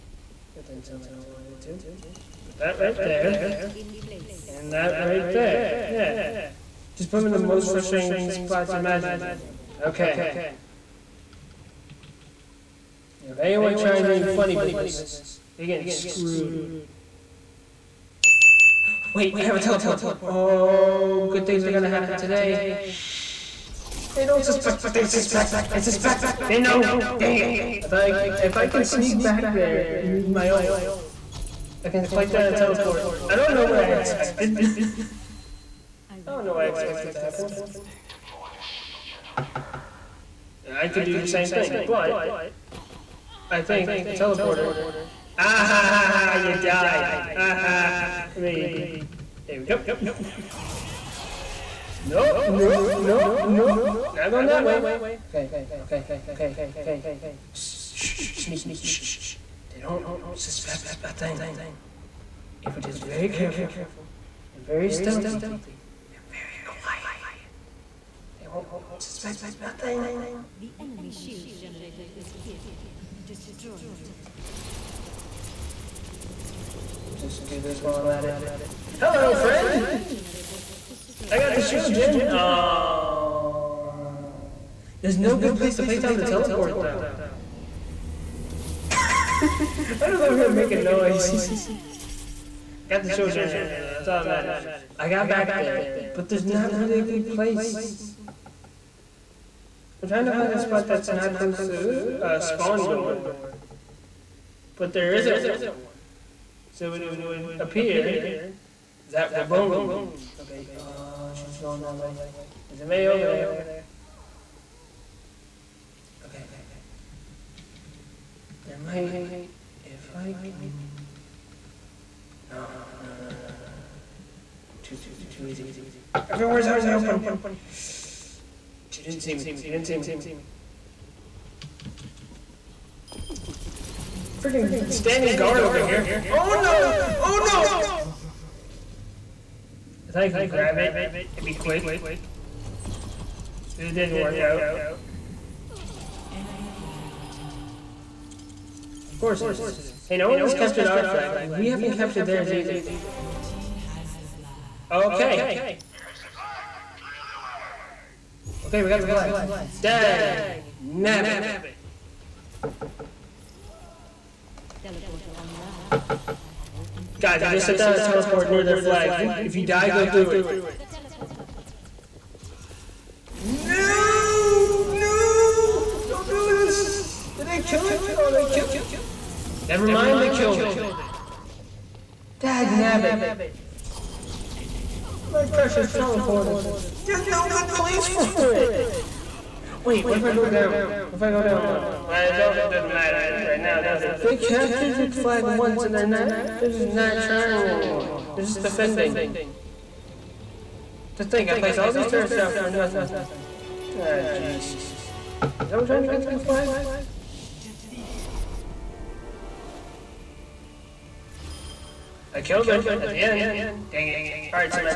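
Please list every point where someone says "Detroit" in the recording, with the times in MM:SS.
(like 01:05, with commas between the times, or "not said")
not said.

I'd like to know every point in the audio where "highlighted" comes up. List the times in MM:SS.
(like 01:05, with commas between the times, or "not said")
not said.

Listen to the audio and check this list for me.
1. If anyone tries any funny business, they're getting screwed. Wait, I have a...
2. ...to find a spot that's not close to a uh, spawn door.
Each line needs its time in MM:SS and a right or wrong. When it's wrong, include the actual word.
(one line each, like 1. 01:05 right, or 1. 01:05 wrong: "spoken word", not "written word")
1. 00:13 right
2. 01:40 right.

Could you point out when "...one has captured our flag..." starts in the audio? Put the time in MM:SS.
02:30.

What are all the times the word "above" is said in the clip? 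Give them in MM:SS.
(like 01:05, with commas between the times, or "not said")
not said.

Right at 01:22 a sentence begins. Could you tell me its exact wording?
Uh, There's no good place to place down the teleport, though.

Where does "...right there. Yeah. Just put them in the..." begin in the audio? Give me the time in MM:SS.
00:05.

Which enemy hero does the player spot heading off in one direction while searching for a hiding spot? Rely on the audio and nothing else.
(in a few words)
Mei.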